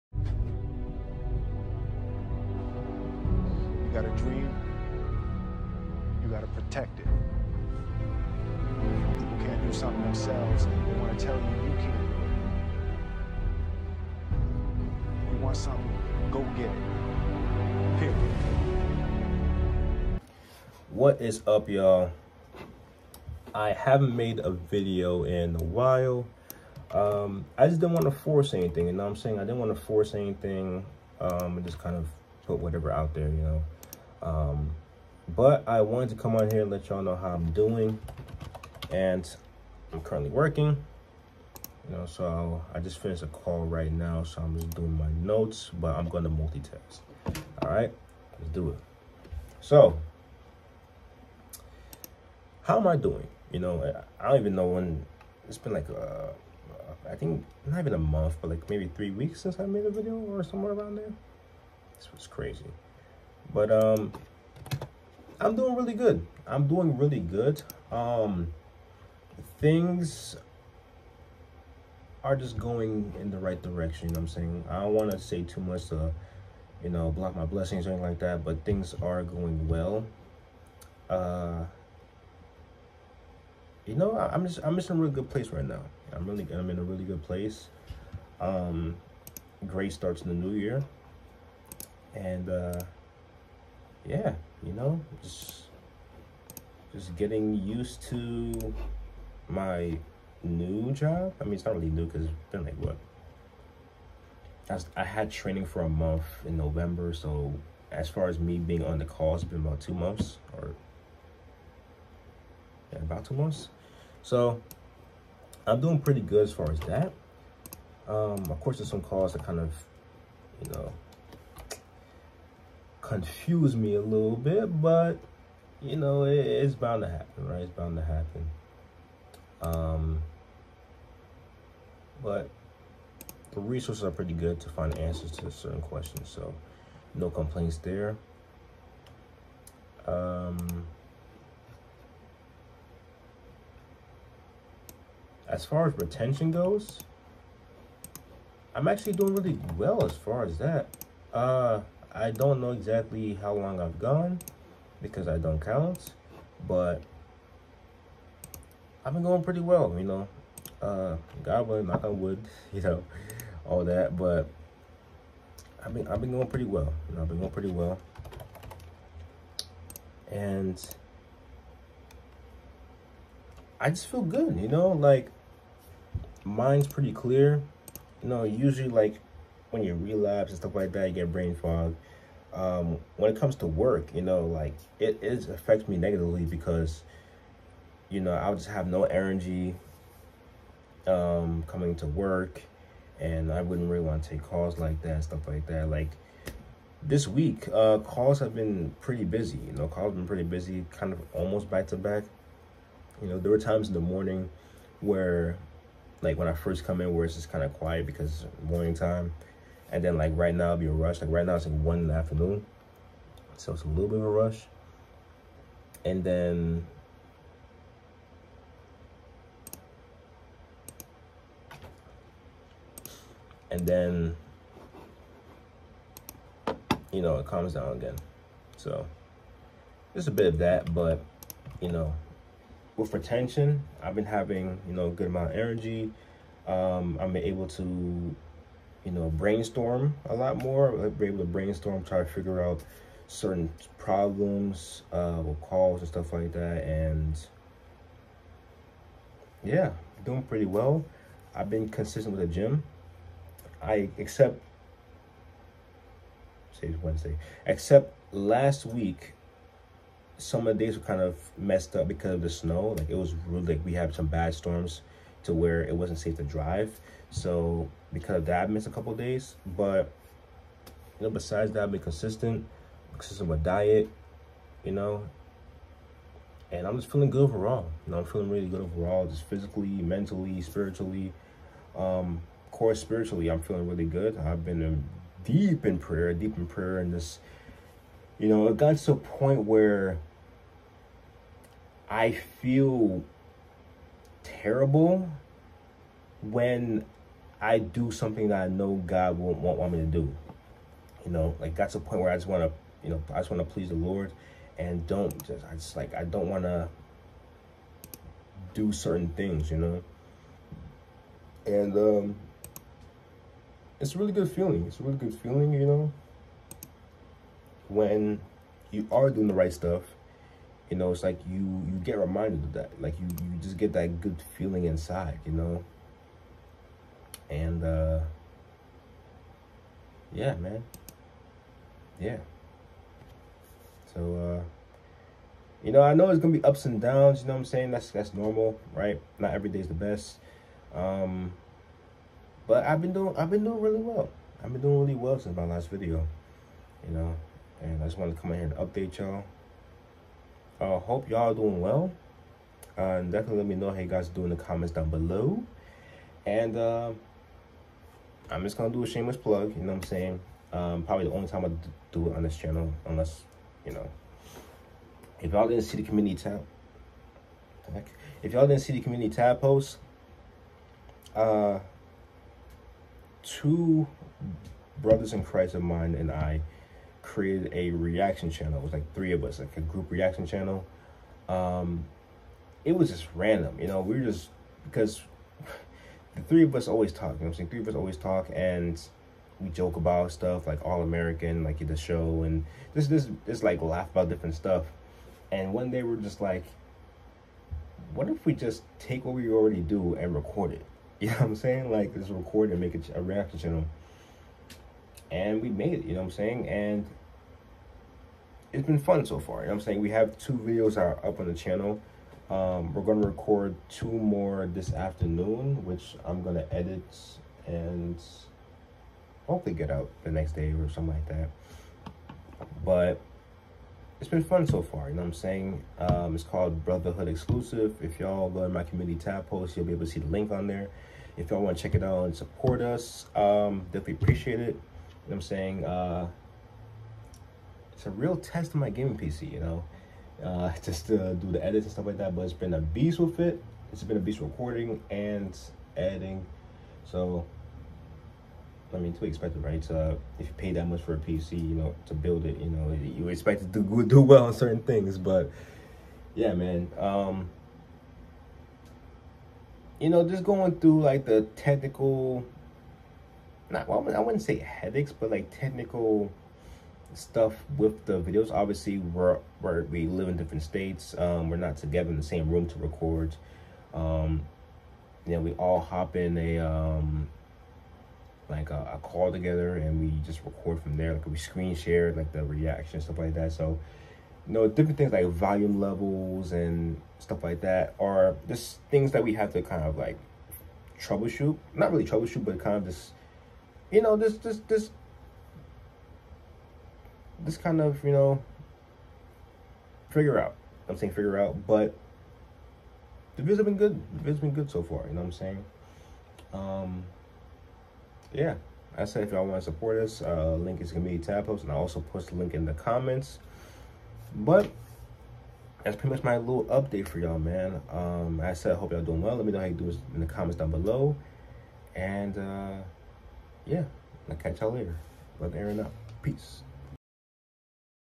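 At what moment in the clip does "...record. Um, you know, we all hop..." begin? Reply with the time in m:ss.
7:52.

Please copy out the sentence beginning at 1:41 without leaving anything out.
I mean, it's not really new because it's been like what?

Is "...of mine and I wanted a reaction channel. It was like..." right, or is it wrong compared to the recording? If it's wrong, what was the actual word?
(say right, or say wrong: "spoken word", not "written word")
wrong: "created", not "wanted".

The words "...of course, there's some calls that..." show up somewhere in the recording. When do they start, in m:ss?
1:58.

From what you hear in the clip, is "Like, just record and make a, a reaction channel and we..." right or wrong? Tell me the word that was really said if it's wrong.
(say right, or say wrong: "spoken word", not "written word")
right.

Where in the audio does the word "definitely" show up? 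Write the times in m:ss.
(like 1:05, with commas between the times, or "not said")
5:53, 7:13.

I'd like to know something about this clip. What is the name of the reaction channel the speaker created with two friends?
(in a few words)
Brotherhood Exclusive.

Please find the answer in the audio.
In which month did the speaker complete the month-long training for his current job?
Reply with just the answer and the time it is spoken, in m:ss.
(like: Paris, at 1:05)
November, at 1:46.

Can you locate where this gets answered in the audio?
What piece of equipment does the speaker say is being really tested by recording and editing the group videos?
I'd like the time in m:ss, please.
7:18.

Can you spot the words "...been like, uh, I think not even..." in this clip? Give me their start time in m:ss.
0:55.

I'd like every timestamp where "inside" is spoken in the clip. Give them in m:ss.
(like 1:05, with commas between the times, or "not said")
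5:24.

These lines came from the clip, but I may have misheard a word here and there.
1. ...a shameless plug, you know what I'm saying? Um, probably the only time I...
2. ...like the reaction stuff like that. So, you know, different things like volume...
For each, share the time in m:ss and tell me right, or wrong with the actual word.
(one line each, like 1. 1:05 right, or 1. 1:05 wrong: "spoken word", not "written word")
1. 5:59 right
2. 8:02 right.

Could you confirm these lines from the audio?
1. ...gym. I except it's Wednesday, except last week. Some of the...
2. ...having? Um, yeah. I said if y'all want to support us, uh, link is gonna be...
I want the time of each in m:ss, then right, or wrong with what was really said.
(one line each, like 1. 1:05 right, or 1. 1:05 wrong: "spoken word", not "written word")
1. 4:12 right
2. 8:25 wrong: "saying", not "having".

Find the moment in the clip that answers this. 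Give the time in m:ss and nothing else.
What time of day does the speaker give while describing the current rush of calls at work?
3:31.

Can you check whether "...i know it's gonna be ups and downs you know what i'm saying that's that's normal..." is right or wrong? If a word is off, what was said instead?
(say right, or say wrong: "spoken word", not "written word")
right.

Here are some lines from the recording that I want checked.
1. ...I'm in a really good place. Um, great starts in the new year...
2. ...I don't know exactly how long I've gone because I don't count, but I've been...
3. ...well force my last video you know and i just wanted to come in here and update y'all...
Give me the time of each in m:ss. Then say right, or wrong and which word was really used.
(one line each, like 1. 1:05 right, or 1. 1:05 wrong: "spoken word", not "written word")
1. 1:26 right
2. 2:32 right
3. 5:45 wrong: "since", not "force".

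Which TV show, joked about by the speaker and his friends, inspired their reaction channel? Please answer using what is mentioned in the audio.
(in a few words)
All American.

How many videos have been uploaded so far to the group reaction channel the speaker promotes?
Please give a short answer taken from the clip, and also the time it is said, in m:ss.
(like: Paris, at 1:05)
2, at 6:50.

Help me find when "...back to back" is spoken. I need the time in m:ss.
3:21.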